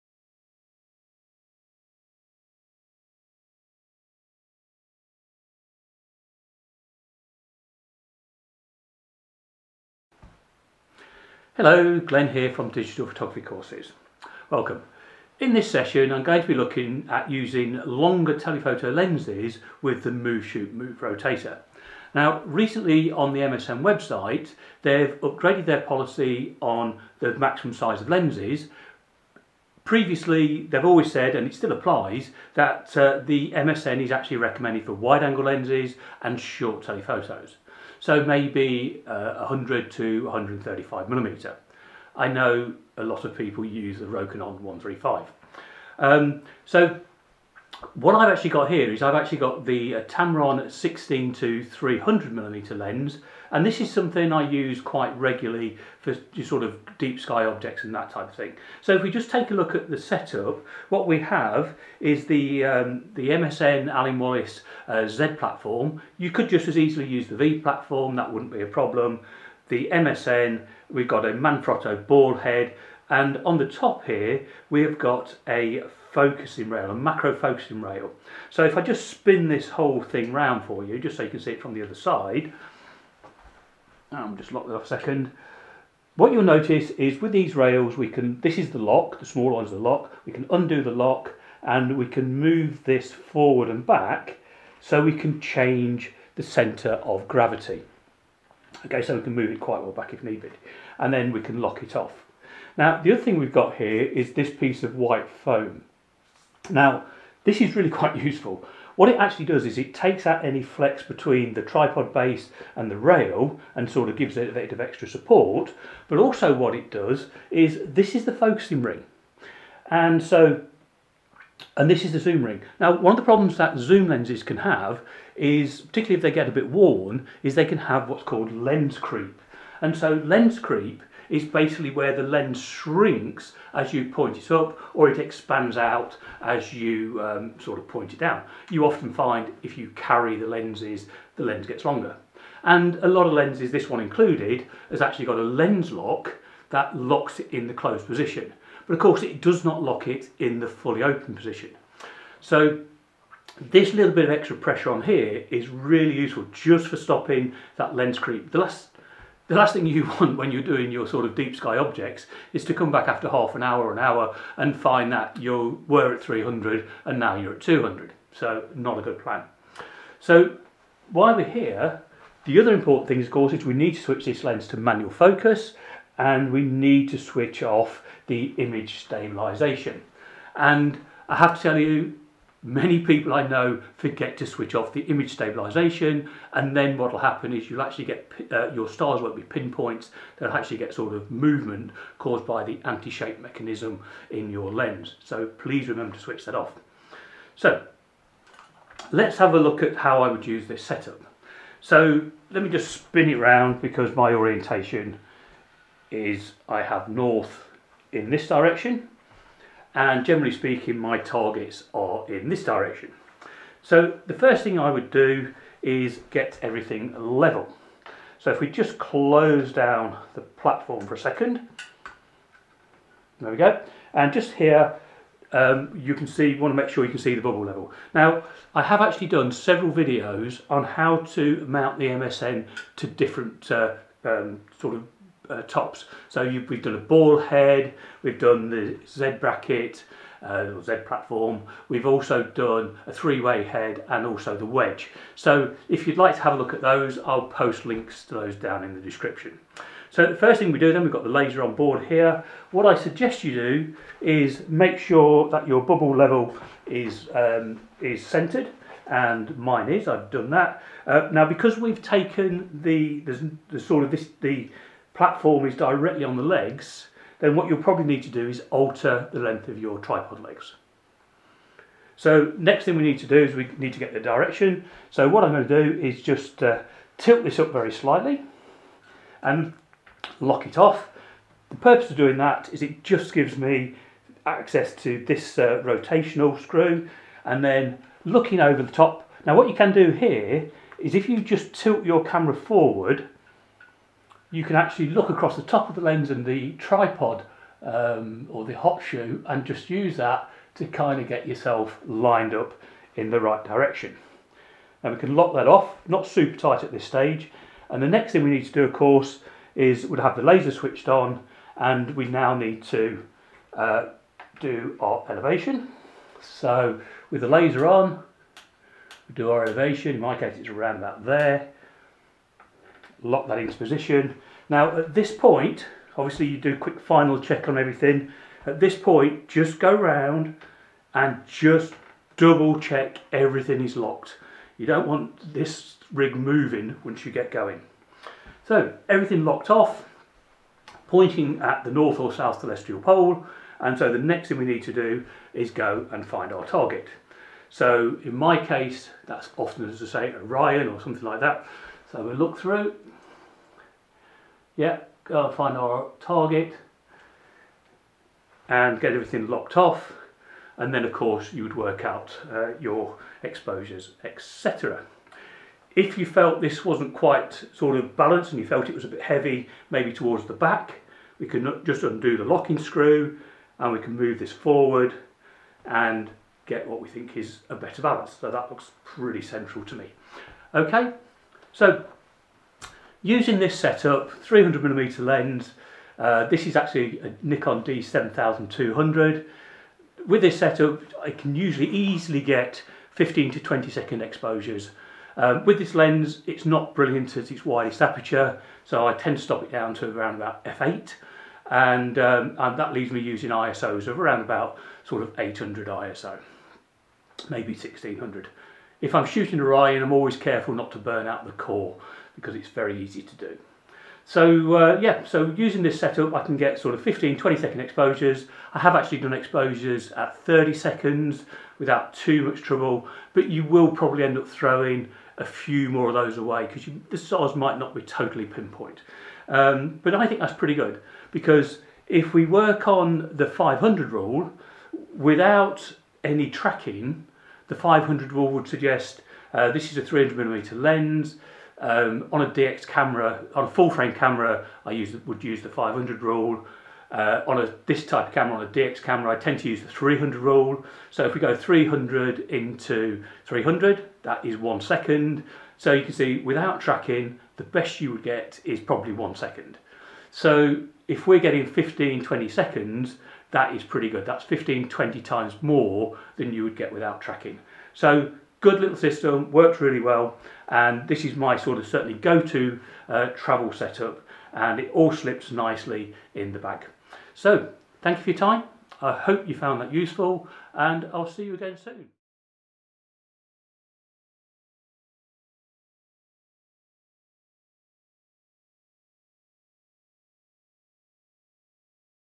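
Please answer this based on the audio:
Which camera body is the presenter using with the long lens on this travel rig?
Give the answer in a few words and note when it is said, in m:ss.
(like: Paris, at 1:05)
Nikon D7200, at 6:27.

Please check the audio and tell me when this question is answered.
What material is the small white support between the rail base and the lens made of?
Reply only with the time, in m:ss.
1:45.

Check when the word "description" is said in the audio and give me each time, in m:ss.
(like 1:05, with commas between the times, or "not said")
4:09.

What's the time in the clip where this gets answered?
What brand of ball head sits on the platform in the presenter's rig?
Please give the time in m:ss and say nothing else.
1:11.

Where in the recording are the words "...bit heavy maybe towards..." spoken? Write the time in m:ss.
6:09.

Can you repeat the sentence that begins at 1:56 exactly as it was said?
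But also what it does is this is the focusing ring.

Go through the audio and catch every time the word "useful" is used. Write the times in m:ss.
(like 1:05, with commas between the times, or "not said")
1:48, 2:36, 7:59.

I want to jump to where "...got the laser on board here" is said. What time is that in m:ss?
4:11.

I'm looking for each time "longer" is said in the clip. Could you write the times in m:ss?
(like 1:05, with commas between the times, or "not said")
0:17, 2:21.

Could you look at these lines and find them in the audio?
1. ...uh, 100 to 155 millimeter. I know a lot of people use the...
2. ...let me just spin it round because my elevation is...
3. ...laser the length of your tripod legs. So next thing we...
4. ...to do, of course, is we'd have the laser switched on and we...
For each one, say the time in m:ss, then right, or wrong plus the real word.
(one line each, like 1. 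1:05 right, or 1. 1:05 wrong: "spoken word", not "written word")
1. 0:39 wrong: "135", not "155"
2. 3:22 wrong: "orientation", not "elevation"
3. 4:28 wrong: "alter", not "laser"
4. 5:08 right.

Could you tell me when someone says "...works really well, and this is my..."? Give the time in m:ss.
7:49.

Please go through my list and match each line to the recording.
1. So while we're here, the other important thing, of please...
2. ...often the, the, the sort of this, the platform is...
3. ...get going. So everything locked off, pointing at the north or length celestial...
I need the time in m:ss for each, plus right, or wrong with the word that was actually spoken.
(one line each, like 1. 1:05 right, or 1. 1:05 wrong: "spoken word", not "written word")
1. 2:50 wrong: "course", not "please"
2. 4:22 wrong: "taken", not "often"
3. 5:37 wrong: "south", not "length".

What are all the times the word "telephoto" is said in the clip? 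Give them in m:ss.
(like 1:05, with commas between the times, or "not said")
0:18, 0:36.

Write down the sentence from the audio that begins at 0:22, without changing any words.
Now recently on the MSM website they've upgraded their policy on the maximum size of lenses.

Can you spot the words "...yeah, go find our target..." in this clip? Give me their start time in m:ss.
5:54.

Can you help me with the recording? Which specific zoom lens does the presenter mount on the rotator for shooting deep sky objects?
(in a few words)
Tamron 16-300mm.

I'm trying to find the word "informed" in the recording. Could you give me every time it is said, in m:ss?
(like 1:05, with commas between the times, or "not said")
not said.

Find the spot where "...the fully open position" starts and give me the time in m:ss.
2:30.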